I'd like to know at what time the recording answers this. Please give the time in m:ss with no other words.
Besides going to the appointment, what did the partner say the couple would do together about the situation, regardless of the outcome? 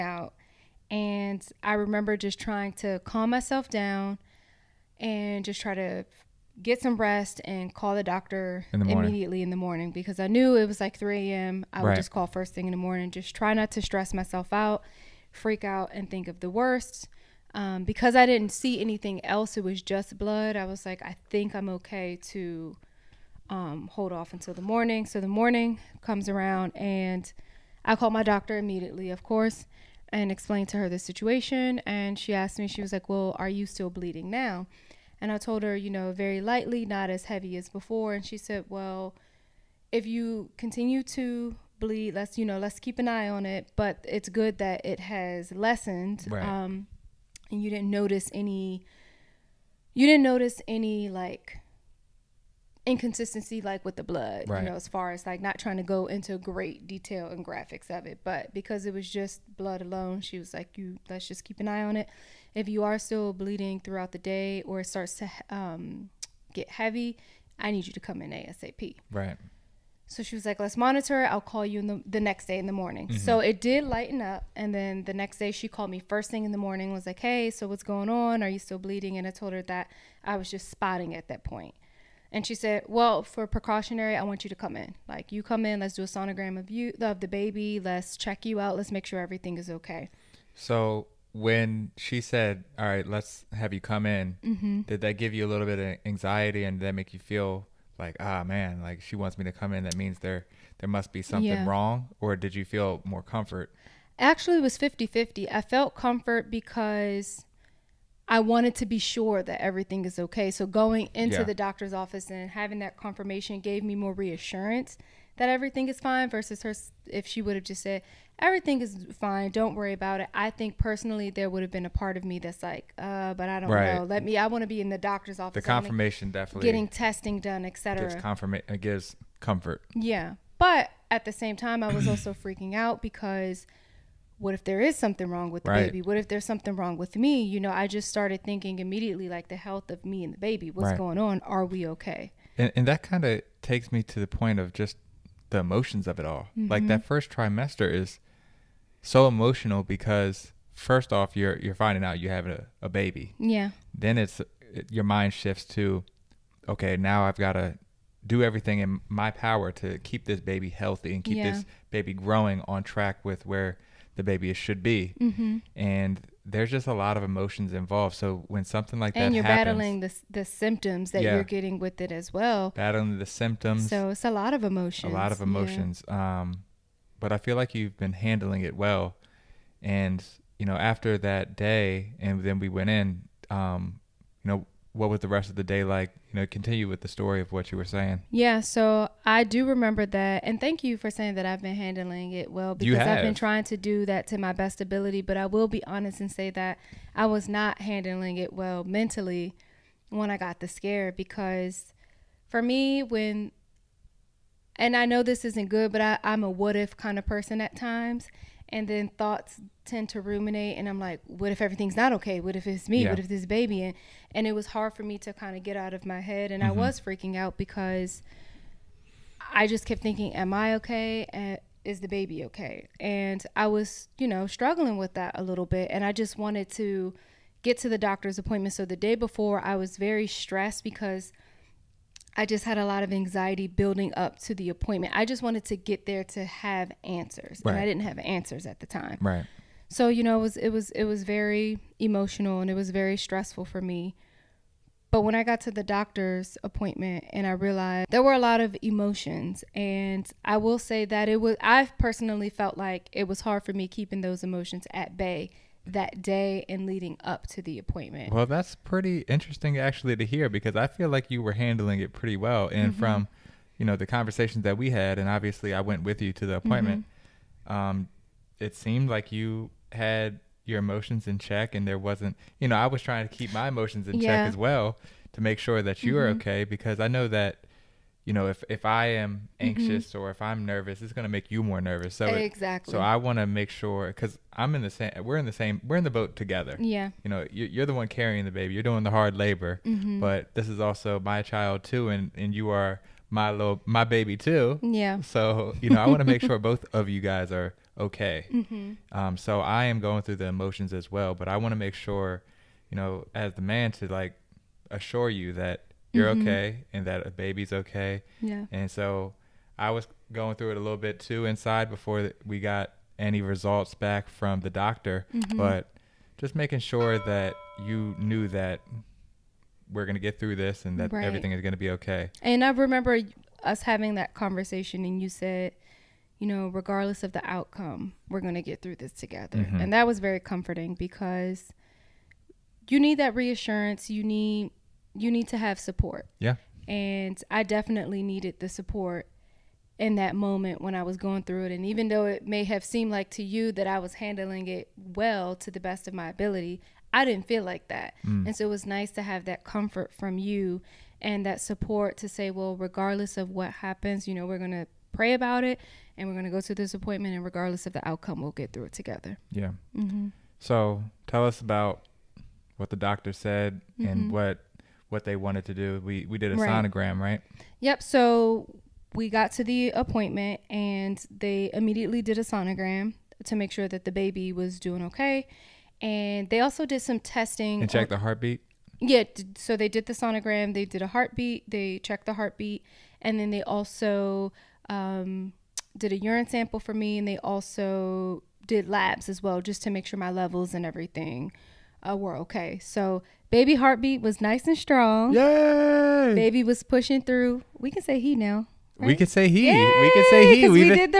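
5:55.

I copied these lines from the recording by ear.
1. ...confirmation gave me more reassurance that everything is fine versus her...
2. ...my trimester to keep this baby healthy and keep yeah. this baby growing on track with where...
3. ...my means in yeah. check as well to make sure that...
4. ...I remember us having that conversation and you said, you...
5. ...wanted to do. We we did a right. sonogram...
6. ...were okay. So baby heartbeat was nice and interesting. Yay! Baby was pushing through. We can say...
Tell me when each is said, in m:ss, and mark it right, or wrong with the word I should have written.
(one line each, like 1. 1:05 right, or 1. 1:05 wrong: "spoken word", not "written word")
1. 1:52 right
2. 2:39 wrong: "power", not "trimester"
3. 4:33 wrong: "emotions", not "means"
4. 5:22 right
5. 6:05 right
6. 6:32 wrong: "strong", not "interesting".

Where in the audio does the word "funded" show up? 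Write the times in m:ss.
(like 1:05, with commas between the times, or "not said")
not said.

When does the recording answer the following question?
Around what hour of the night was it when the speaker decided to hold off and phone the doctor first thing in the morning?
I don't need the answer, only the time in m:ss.
0:10.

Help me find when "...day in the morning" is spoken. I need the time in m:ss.
1:12.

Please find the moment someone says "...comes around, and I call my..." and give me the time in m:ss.
0:26.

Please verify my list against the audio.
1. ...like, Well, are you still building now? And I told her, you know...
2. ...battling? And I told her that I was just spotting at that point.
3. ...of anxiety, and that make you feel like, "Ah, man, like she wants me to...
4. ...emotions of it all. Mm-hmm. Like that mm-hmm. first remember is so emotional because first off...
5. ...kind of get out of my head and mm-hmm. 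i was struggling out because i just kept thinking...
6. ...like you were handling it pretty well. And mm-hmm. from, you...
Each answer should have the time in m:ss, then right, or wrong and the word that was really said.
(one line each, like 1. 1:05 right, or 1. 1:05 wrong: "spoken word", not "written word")
1. 0:32 wrong: "bleeding", not "building"
2. 1:18 wrong: "bleeding", not "battling"
3. 1:35 right
4. 2:25 wrong: "trimester", not "remember"
5. 3:35 wrong: "freaking", not "struggling"
6. 4:21 right.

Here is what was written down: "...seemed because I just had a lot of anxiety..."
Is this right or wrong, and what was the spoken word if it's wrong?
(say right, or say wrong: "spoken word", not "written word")
wrong: "stressed", not "seemed".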